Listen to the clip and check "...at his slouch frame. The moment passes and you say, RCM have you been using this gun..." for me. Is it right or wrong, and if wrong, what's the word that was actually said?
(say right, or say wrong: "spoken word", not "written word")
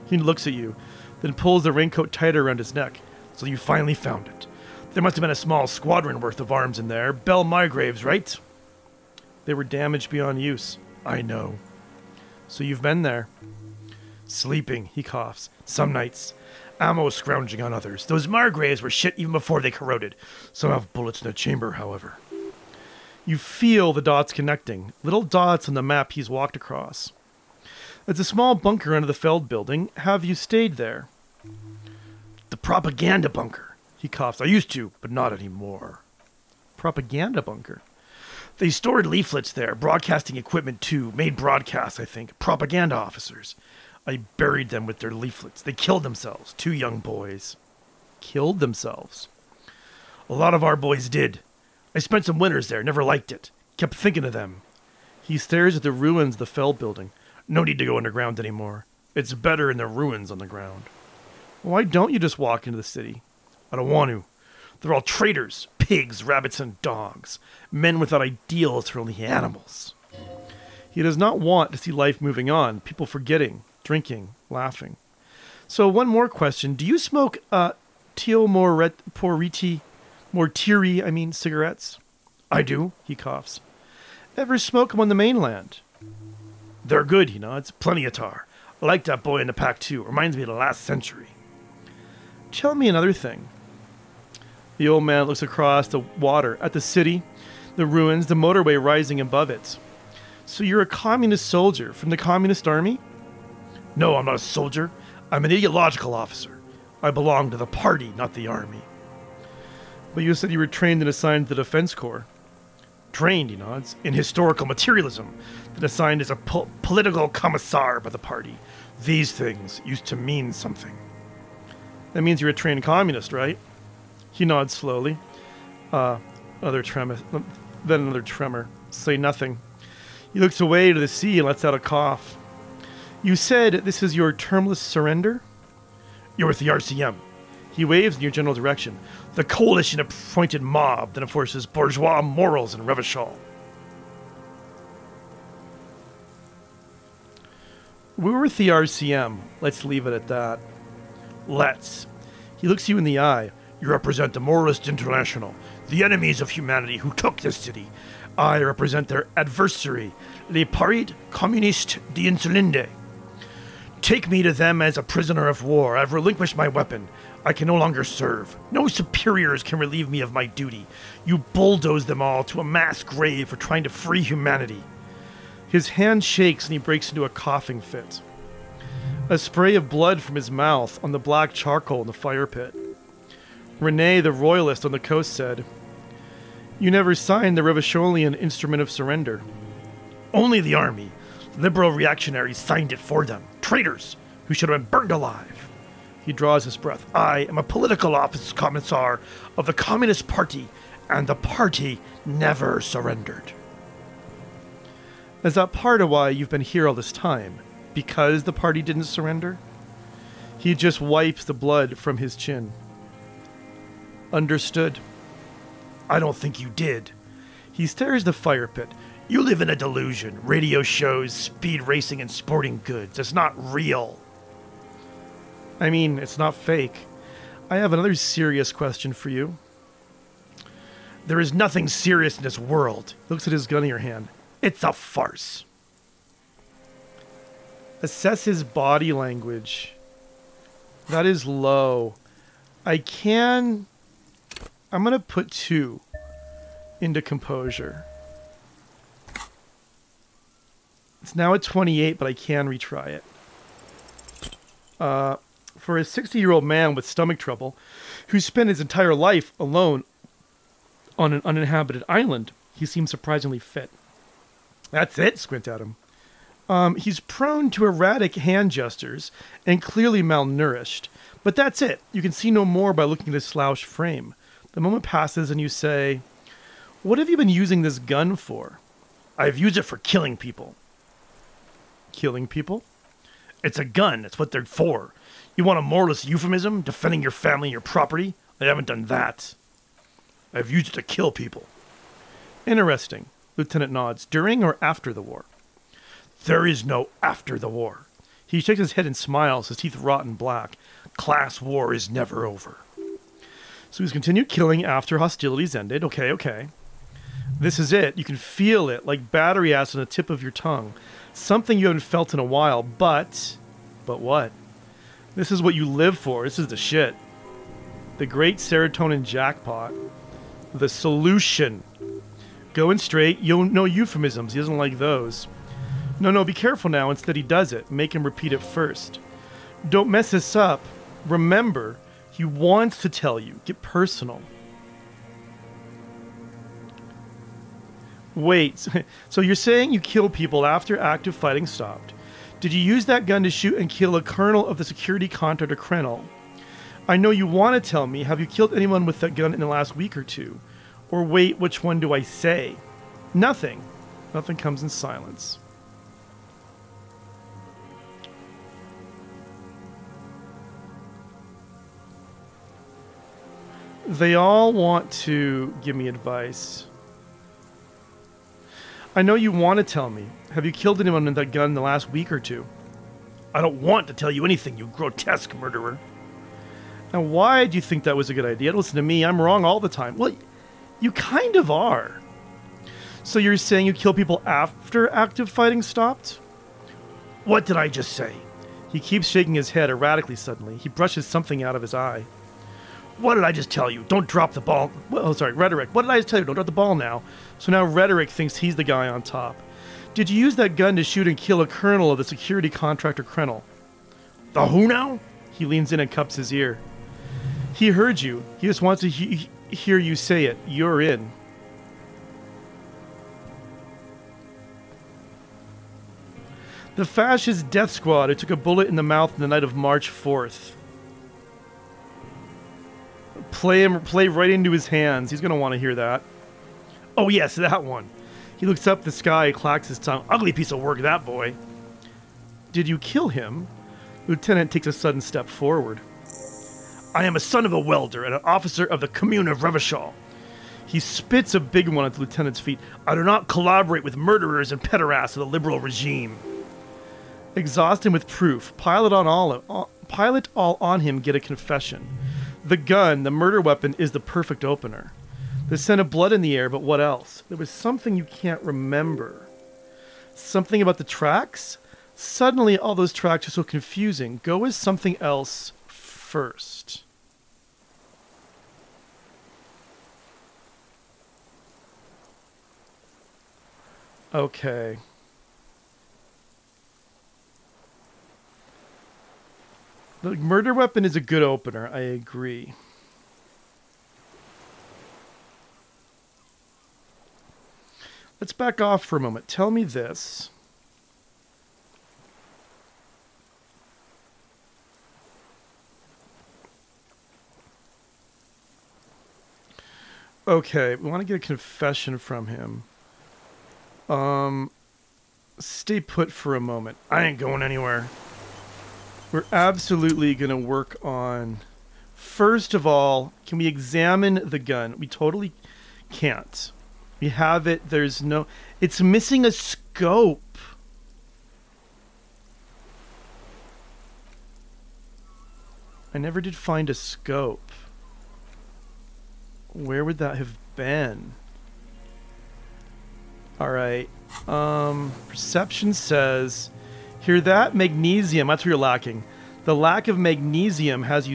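wrong: "What", not "RCM".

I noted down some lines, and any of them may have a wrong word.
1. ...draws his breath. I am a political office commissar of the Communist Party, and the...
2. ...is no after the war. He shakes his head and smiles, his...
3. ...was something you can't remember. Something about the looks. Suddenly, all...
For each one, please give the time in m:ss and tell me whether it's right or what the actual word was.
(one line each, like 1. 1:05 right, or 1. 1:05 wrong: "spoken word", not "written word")
1. 3:16 right
2. 4:56 right
3. 7:37 wrong: "tracks", not "looks".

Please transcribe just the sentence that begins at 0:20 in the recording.
Some have bullets in the chamber, however.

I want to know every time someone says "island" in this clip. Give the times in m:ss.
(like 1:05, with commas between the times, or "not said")
4:22.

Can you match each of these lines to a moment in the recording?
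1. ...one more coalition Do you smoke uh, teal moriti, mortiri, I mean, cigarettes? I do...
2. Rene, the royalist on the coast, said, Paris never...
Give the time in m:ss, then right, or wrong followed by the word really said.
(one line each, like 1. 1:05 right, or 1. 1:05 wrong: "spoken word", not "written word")
1. 1:15 wrong: "question", not "coalition"
2. 3:03 wrong: "You", not "Paris".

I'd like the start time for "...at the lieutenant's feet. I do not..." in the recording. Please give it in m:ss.
7:22.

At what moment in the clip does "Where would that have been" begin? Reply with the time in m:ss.
8:49.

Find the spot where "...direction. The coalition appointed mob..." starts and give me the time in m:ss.
2:18.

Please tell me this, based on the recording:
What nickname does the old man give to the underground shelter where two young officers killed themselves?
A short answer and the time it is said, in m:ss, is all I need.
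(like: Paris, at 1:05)
The propaganda bunker, at 0:32.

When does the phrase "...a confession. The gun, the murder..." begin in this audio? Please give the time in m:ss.
7:31.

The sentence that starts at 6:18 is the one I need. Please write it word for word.
Listen to me, I'm wrong all the time.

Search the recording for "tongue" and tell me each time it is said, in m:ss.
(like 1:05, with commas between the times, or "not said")
5:10, 7:09.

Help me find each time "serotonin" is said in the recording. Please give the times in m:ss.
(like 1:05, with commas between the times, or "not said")
5:18.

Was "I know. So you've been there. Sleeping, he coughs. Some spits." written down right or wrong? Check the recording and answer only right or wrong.
wrong.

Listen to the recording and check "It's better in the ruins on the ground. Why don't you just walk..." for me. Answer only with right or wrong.
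right.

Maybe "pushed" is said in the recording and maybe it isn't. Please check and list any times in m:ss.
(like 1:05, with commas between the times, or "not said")
not said.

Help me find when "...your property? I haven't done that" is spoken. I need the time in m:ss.
4:47.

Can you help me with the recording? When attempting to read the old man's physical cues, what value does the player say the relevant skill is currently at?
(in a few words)
28.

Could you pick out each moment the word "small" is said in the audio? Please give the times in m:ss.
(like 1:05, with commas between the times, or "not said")
0:05, 0:28.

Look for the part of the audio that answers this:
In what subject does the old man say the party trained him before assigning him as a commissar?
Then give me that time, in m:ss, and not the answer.
1:54.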